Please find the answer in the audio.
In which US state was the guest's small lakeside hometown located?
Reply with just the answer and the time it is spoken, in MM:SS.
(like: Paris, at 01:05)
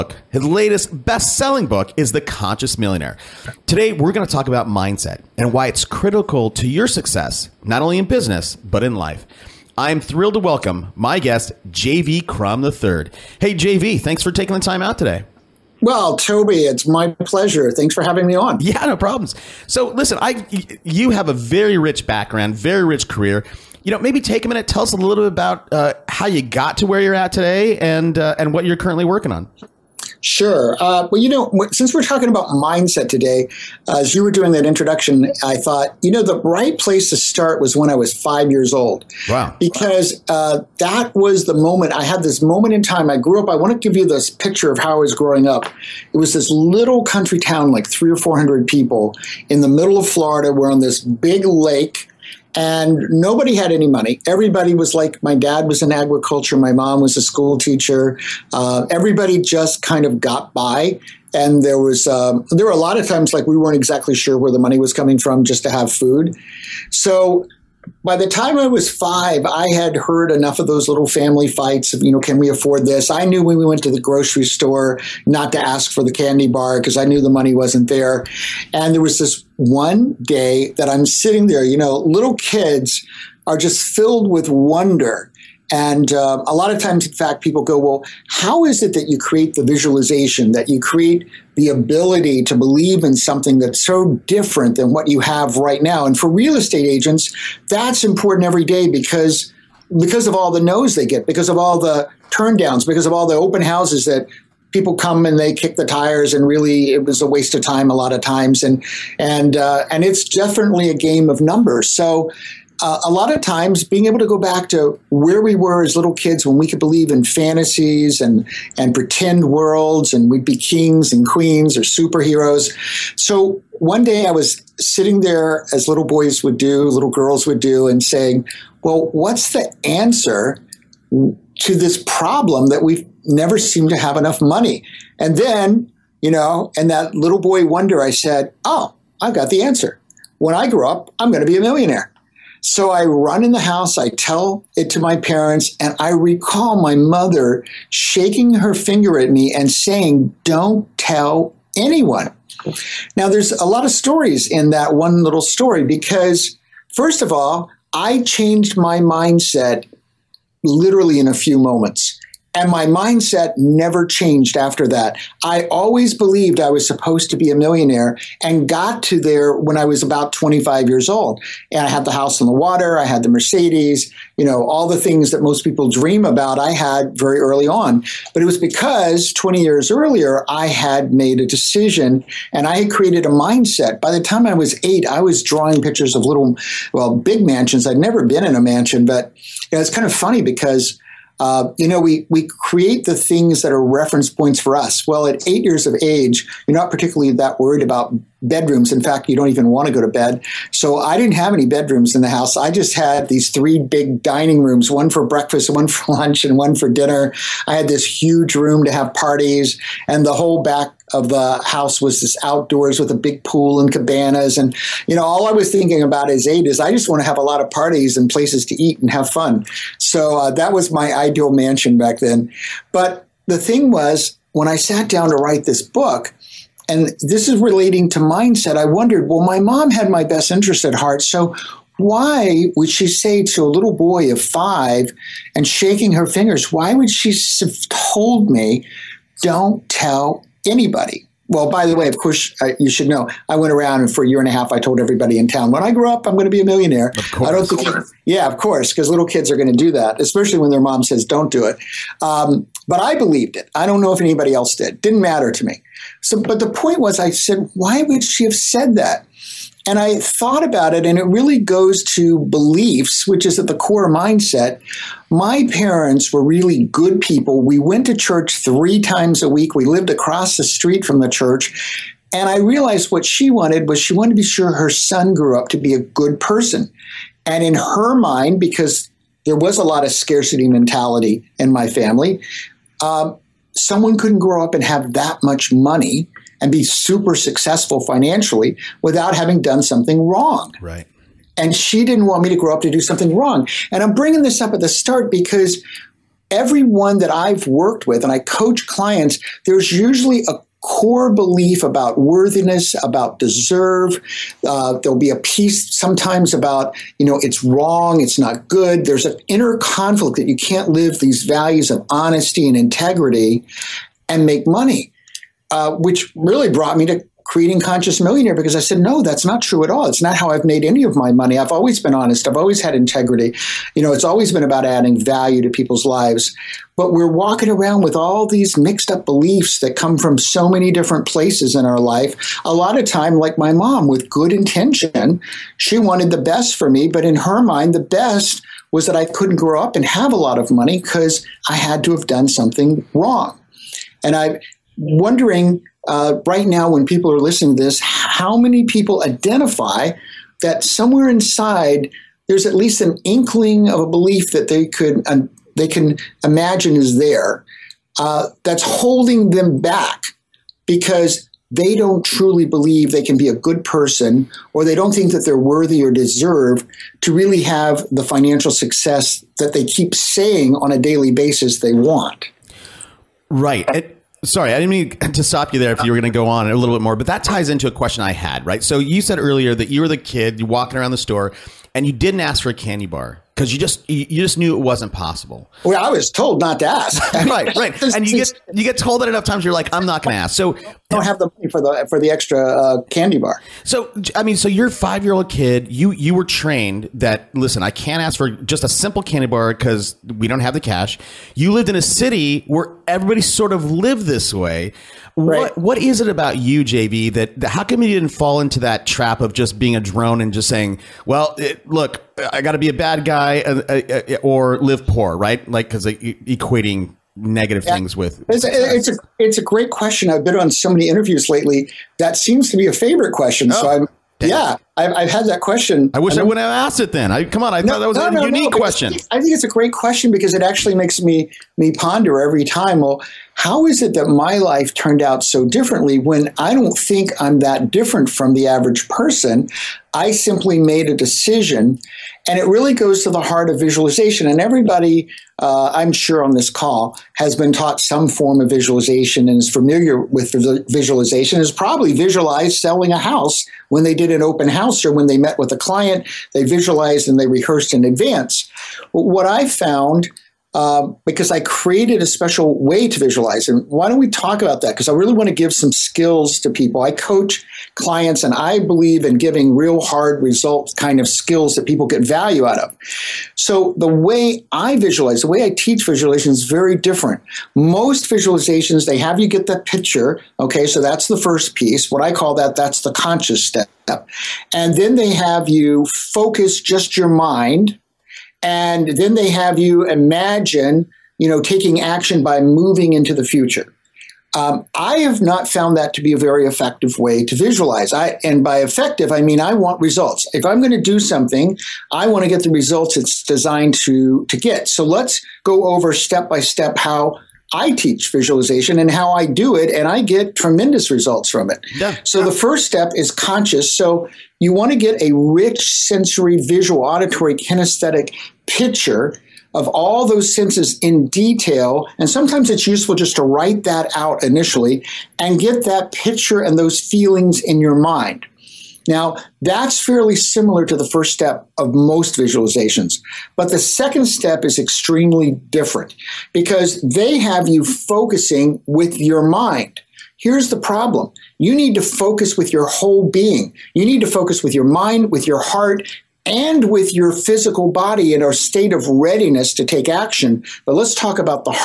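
Florida, at 00:50.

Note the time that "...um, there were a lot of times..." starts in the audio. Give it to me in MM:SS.
01:02.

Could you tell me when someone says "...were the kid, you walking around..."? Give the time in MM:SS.
06:20.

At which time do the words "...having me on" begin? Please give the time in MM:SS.
00:18.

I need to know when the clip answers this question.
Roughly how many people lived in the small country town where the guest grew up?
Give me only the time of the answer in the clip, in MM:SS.
00:47.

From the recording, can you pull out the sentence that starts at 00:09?
I'm thrilled to welcome my guest, JV Crum III.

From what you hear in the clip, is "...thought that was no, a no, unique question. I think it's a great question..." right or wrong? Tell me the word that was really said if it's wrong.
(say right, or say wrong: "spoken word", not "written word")
right.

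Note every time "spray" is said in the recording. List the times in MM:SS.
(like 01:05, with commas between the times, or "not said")
not said.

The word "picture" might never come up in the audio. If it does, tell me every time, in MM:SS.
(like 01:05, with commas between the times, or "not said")
00:44, 03:05, 07:59, 08:38, 08:46.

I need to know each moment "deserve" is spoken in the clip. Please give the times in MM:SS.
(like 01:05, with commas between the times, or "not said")
05:03, 06:06.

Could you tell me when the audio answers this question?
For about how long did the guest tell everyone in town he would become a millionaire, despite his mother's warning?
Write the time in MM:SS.
04:04.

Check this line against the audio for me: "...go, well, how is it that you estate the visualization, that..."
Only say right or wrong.
wrong.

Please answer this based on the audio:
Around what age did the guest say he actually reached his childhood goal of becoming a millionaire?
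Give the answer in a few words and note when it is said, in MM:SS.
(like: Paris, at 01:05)
25, at 02:50.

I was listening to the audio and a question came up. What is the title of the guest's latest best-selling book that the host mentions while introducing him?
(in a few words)
The Conscious Millionaire.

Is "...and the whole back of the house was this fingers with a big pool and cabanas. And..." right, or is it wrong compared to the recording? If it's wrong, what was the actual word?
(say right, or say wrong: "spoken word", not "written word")
wrong: "outdoors", not "fingers".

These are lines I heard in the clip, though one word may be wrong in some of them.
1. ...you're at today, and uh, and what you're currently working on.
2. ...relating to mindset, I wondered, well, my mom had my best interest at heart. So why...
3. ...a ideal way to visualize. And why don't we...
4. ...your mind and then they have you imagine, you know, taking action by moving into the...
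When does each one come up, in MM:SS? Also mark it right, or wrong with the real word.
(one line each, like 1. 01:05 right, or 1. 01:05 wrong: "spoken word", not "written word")
1. 00:27 right
2. 03:47 right
3. 07:42 wrong: "special", not "ideal"
4. 08:07 right.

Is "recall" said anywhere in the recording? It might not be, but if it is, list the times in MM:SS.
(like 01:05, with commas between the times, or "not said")
02:26.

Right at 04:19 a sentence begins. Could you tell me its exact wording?
And I thought about it, and it really goes to beliefs, which is at the core mindset.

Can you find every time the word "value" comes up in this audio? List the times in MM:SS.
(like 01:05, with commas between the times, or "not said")
05:11, 05:25, 07:52.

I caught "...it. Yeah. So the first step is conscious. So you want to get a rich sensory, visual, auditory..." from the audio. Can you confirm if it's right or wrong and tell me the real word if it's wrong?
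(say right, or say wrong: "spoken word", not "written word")
right.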